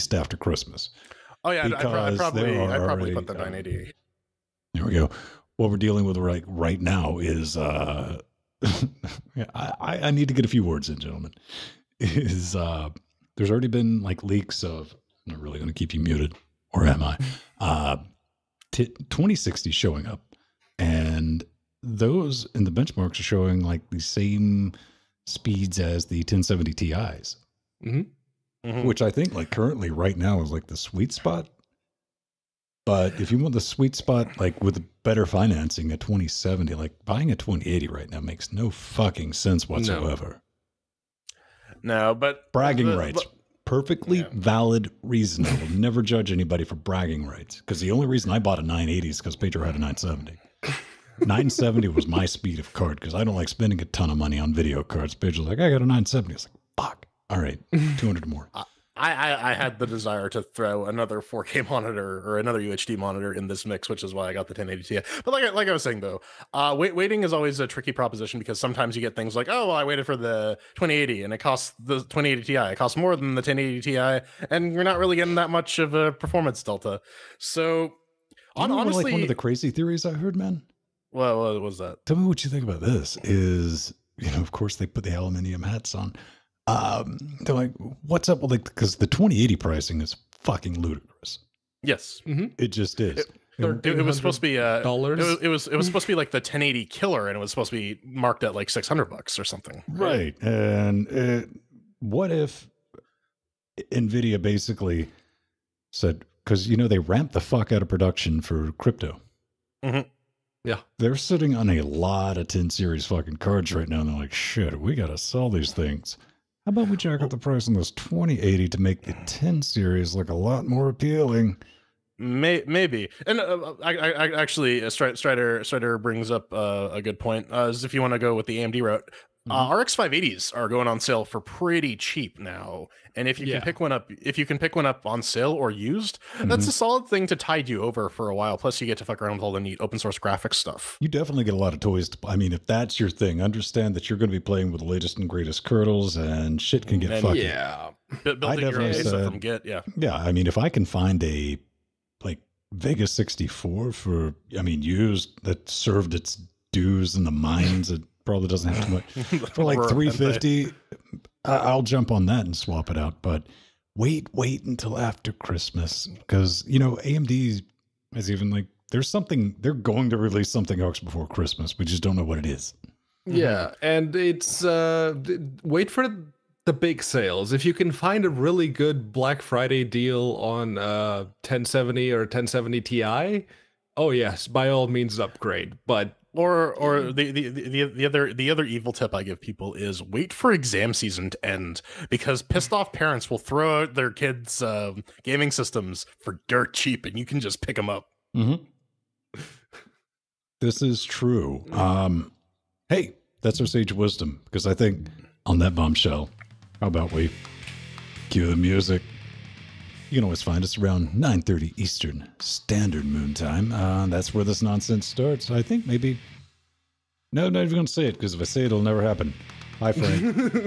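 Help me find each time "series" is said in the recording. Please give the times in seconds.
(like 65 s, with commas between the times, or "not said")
112 s, 119 s.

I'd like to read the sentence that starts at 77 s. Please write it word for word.
So you know, honestly, like one of the crazy theories I heard, man.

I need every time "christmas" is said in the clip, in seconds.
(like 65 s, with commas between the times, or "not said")
0 s, 165 s, 171 s.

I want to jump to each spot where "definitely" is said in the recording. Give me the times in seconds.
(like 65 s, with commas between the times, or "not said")
141 s, 148 s.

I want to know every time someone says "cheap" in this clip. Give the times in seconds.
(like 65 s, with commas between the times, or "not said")
131 s, 196 s.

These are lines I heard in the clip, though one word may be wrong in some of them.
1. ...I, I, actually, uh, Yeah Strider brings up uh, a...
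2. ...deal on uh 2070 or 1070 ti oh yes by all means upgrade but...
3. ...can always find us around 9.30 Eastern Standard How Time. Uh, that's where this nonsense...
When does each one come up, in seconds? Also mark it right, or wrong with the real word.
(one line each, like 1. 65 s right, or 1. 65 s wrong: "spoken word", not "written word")
1. 123 s wrong: "Strider", not "Yeah"
2. 179 s wrong: "1070", not "2070"
3. 210 s wrong: "Moon", not "How".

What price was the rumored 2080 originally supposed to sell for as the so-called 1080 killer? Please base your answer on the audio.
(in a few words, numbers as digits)
600 bucks.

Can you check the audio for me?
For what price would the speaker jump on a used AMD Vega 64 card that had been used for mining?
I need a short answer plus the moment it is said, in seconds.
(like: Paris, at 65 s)
350, at 159 s.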